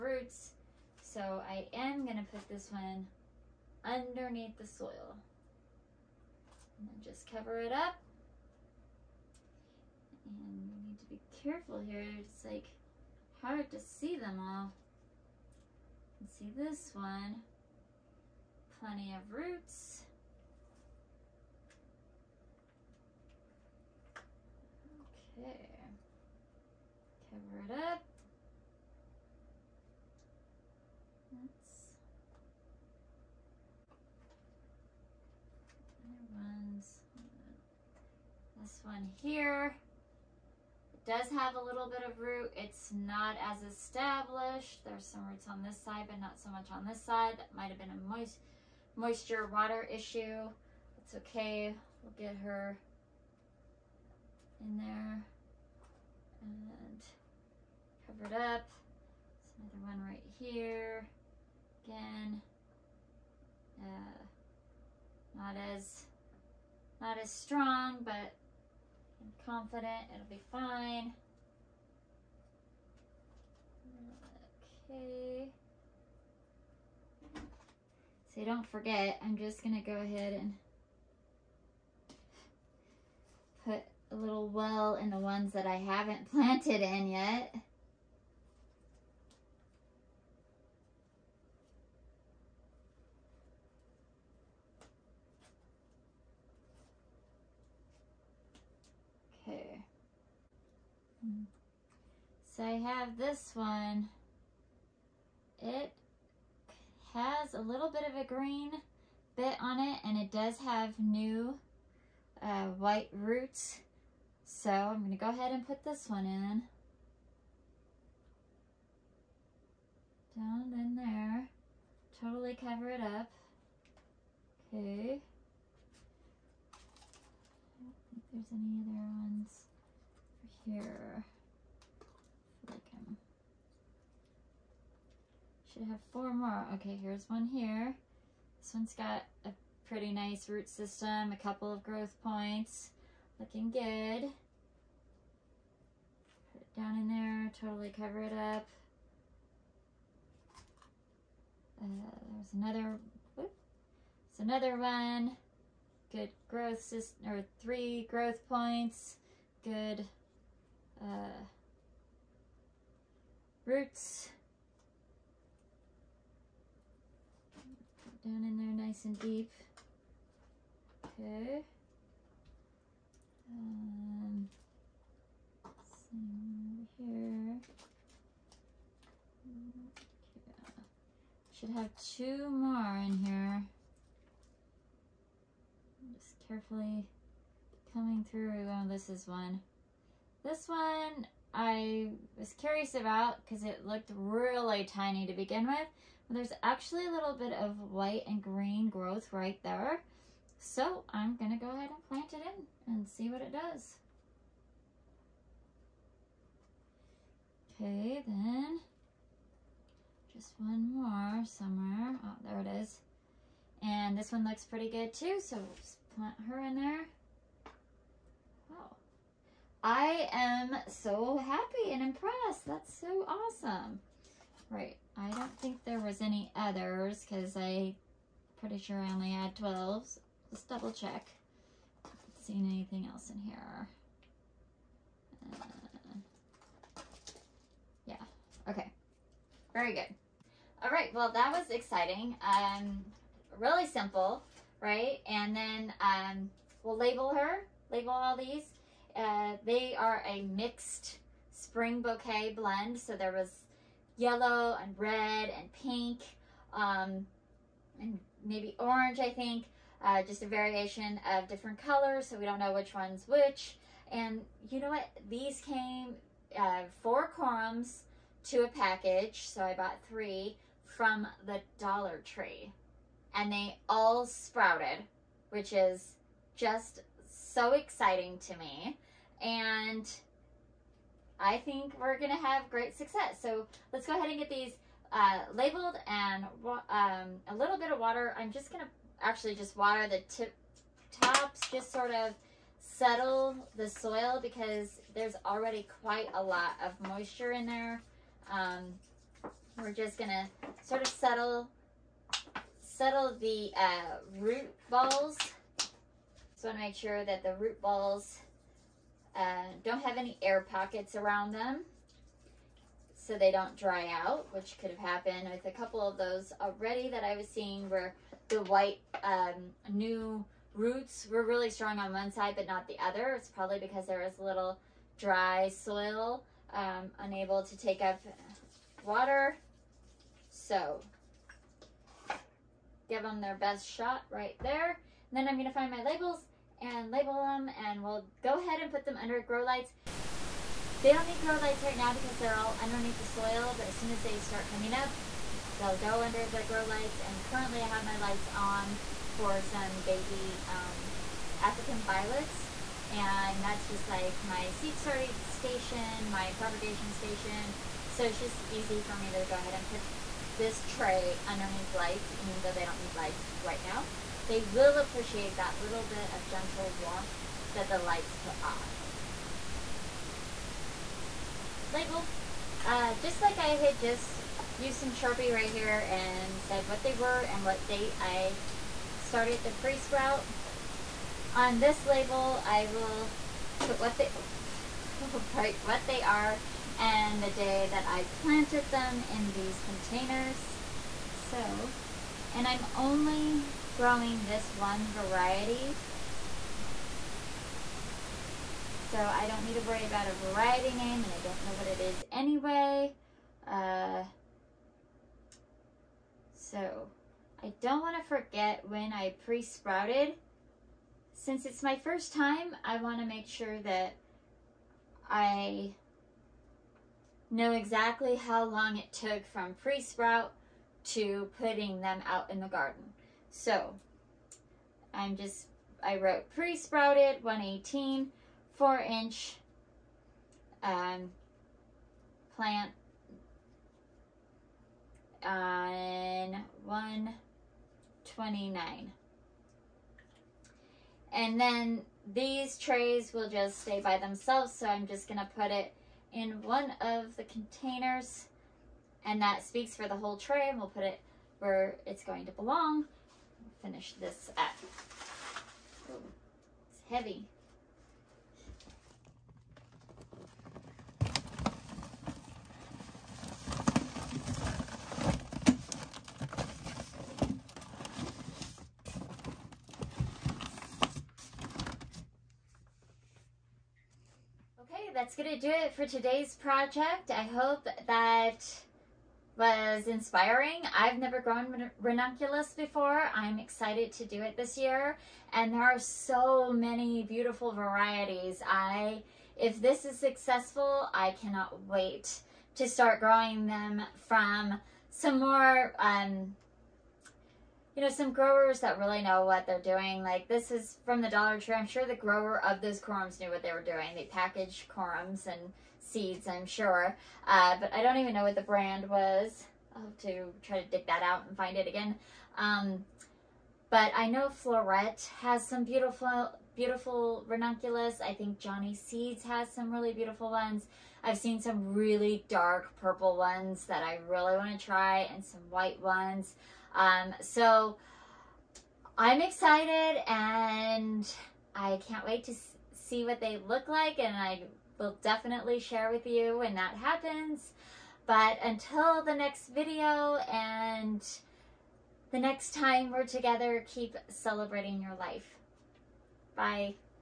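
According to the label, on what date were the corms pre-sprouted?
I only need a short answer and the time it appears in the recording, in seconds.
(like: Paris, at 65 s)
1/18, at 427 s.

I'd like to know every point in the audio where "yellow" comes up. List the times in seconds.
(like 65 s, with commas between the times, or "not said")
254 s.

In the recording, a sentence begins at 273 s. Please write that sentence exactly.
And they all sprouted, which is just so exciting to me.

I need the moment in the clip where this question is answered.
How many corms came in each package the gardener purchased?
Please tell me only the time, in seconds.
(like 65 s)
267 s.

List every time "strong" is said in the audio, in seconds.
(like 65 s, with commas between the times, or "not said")
67 s, 321 s.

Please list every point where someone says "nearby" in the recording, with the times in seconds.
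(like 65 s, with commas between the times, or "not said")
not said.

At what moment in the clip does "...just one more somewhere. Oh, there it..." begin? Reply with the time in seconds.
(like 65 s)
210 s.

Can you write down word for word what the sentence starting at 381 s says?
On this label, I will put what they...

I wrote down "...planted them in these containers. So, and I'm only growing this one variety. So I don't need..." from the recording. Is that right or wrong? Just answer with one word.
right.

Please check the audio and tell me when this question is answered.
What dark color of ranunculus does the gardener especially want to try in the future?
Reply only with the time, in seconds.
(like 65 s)
522 s.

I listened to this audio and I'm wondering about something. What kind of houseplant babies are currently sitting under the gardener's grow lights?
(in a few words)
African violets.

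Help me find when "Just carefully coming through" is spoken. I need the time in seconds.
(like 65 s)
186 s.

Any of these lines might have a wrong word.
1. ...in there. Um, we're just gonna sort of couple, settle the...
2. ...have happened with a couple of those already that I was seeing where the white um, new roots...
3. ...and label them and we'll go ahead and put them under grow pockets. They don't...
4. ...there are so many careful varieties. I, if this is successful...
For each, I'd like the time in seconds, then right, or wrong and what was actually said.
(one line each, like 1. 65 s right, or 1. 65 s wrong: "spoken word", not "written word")
1. 297 s wrong: "settle", not "couple"
2. 314 s right
3. 336 s wrong: "lights", not "pockets"
4. 485 s wrong: "beautiful", not "careful".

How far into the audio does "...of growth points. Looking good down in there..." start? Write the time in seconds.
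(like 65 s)
141 s.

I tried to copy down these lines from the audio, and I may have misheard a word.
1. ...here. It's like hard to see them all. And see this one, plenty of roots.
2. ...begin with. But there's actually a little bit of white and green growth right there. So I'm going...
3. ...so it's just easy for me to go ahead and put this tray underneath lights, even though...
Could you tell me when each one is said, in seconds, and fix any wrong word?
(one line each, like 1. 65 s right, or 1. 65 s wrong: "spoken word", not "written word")
1. 11 s right
2. 195 s right
3. 358 s right.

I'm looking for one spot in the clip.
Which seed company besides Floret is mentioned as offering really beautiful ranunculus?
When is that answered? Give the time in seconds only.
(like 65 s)
518 s.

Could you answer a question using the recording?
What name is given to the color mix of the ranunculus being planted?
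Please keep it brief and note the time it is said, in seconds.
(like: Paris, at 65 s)
mixed spring bouquet blend, at 250 s.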